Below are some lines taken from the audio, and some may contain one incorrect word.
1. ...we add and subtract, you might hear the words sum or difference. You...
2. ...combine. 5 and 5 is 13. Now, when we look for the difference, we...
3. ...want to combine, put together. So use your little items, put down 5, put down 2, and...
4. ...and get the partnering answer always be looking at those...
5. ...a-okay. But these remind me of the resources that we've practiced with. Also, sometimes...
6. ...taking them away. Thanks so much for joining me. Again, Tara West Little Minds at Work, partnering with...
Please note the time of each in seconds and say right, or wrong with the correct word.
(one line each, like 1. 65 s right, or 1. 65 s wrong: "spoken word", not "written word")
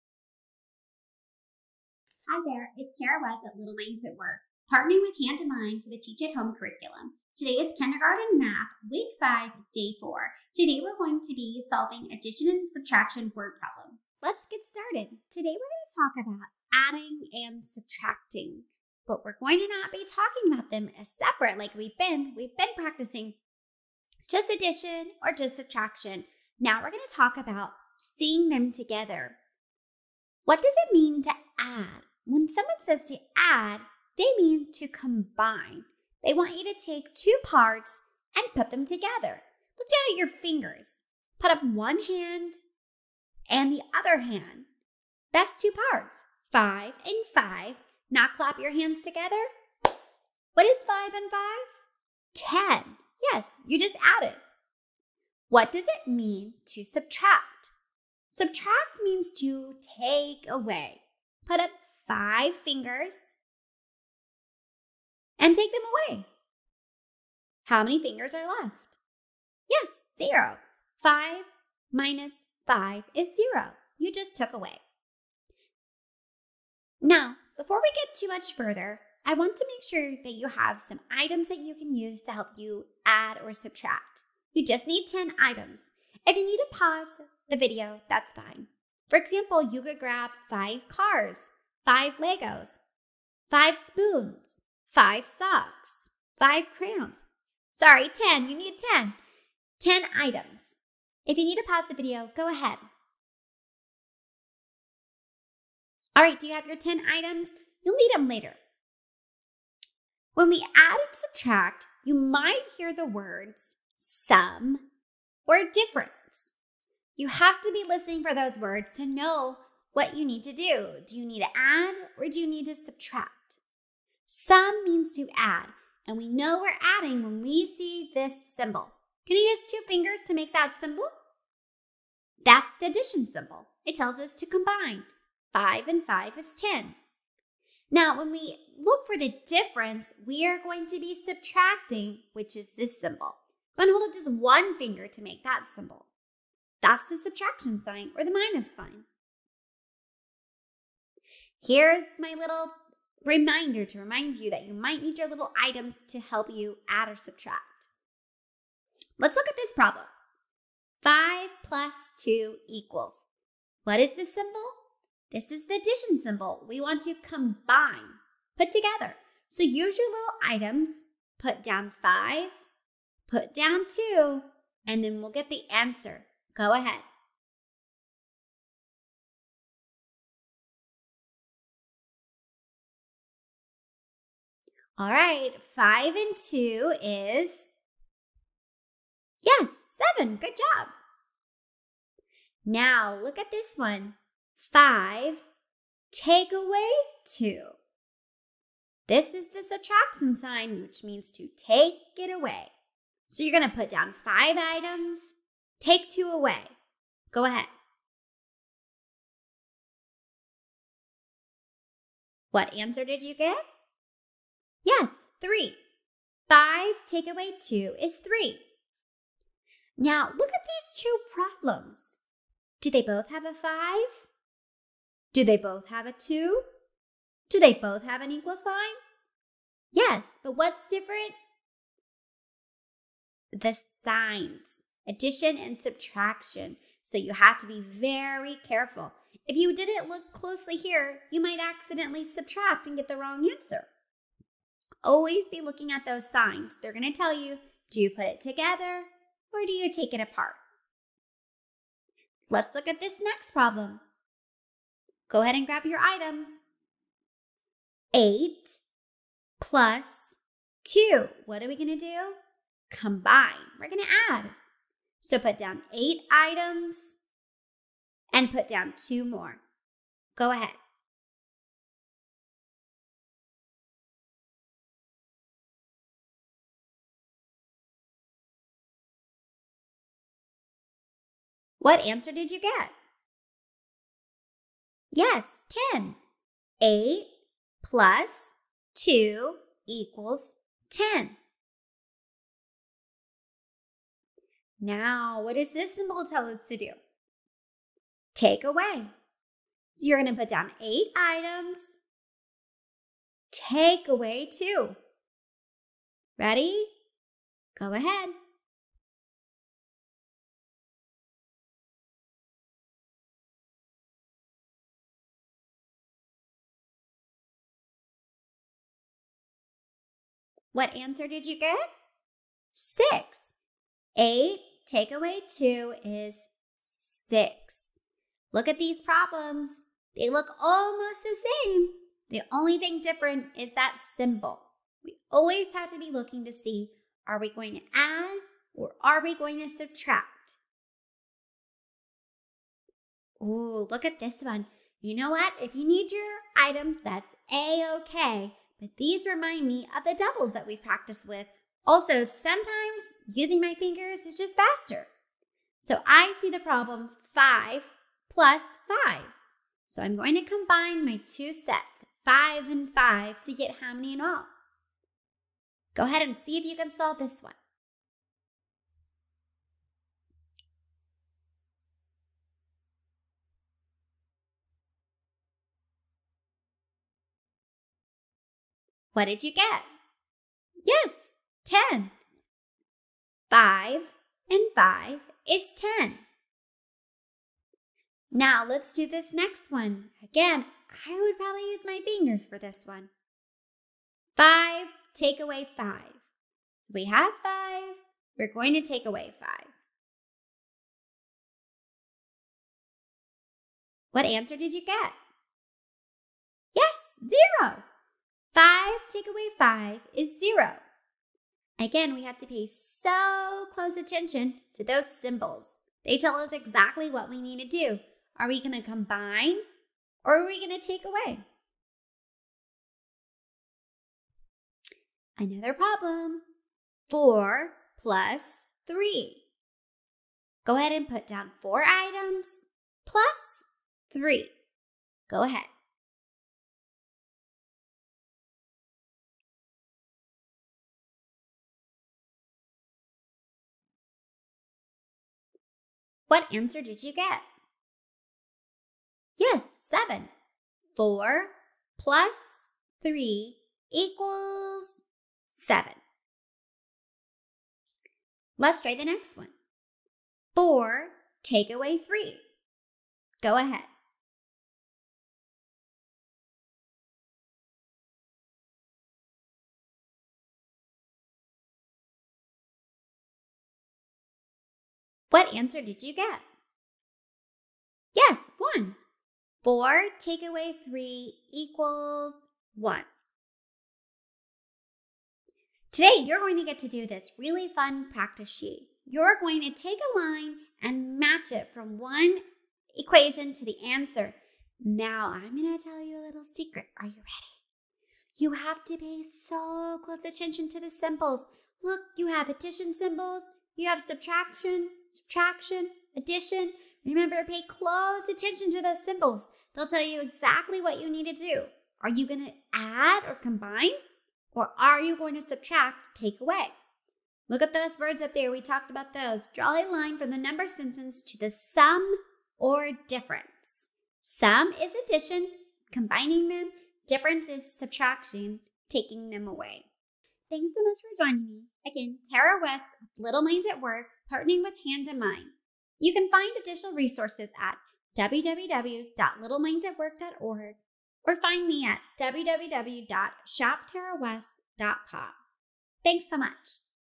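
1. 110 s right
2. 134 s wrong: "10", not "13"
3. 166 s right
4. 242 s wrong: "wrong", not "partnering"
5. 347 s wrong: "doubles", not "resources"
6. 528 s right.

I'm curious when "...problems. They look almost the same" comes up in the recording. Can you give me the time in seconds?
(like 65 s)
329 s.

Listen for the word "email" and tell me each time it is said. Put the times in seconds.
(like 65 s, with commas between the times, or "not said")
not said.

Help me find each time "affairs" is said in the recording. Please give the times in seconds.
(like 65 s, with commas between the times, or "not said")
not said.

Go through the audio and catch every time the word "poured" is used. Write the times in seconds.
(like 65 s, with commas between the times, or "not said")
not said.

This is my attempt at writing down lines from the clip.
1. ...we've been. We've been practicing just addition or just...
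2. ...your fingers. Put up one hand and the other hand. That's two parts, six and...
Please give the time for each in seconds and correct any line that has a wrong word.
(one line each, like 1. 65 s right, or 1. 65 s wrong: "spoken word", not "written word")
1. 21 s right
2. 40 s wrong: "five", not "six".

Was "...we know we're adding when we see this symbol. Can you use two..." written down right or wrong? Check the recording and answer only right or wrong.
right.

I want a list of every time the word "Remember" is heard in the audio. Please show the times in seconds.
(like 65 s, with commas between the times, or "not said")
507 s.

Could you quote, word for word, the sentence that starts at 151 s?
Here's my little reminder to remind you that you might need your little items to help you add or subtract.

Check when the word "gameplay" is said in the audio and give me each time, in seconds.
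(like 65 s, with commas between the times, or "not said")
not said.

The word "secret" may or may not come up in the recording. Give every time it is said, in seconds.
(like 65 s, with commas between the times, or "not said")
496 s.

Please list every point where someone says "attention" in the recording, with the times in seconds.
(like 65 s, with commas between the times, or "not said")
413 s, 500 s, 508 s.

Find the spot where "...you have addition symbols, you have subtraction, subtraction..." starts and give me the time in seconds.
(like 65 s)
502 s.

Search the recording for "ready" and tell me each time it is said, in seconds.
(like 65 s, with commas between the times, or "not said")
306 s, 497 s.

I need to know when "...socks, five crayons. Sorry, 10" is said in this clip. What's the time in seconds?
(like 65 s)
95 s.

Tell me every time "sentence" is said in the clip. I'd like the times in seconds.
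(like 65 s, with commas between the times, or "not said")
520 s.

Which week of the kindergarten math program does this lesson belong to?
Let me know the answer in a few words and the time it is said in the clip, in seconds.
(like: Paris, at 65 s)
week five, at 8 s.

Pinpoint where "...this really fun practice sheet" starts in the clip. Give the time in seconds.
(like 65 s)
487 s.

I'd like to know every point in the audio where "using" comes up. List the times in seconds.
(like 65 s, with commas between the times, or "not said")
353 s.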